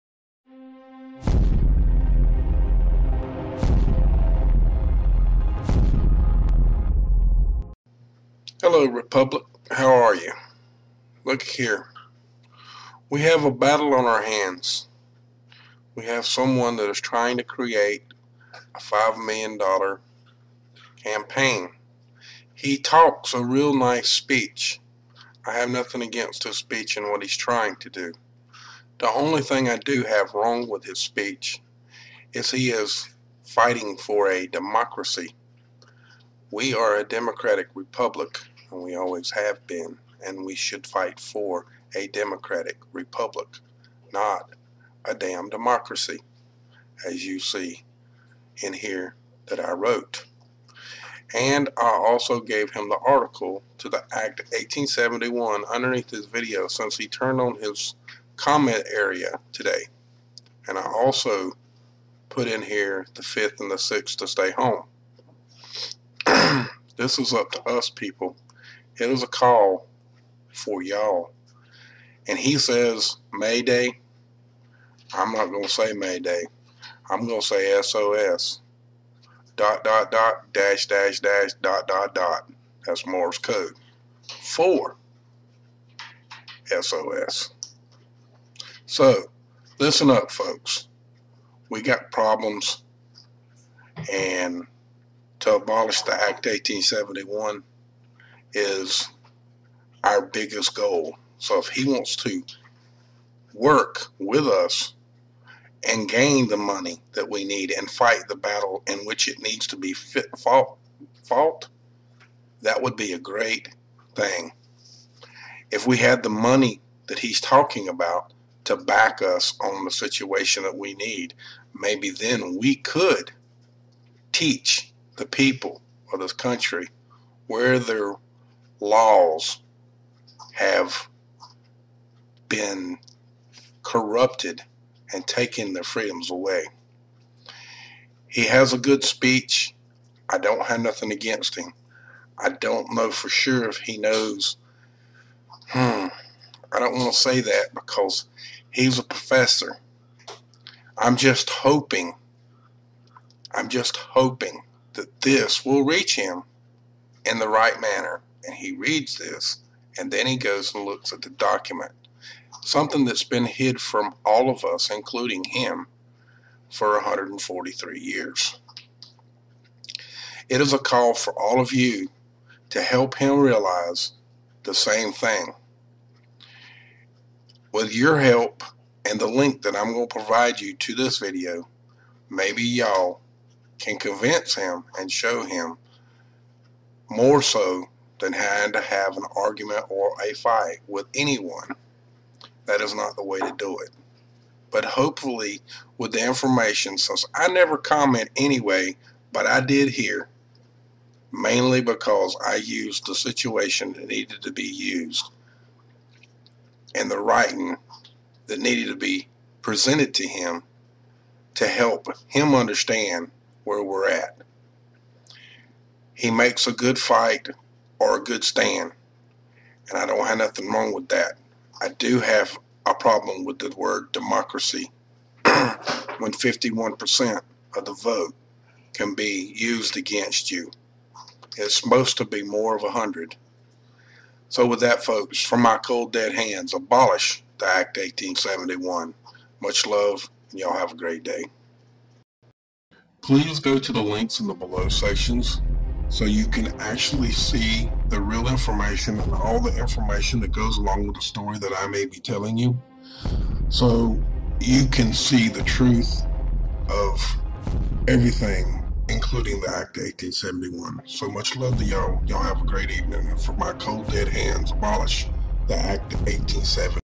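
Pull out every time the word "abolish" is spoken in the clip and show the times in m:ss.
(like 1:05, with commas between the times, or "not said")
1:35, 3:56, 4:24.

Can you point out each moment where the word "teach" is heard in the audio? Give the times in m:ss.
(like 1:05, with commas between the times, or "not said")
2:04.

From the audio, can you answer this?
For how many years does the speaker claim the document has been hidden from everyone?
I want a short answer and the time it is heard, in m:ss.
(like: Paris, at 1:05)
143, at 2:46.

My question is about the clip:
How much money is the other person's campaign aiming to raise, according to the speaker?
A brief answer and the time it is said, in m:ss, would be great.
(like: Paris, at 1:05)
$5 million, at 0:18.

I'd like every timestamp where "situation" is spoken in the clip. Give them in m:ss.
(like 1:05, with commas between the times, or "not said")
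1:59, 3:23.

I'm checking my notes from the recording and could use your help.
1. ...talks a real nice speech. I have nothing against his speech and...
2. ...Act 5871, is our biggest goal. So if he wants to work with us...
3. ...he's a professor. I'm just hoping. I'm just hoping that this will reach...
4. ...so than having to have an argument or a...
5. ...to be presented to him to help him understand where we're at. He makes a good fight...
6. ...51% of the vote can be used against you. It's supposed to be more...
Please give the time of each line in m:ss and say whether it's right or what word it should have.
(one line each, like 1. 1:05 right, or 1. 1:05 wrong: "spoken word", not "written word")
1. 0:22 right
2. 1:36 wrong: "1871", not "5871"
3. 2:28 right
4. 3:07 right
5. 3:28 right
6. 3:46 right.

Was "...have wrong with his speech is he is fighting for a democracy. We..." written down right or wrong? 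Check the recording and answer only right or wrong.
right.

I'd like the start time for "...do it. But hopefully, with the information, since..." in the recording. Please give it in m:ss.
3:13.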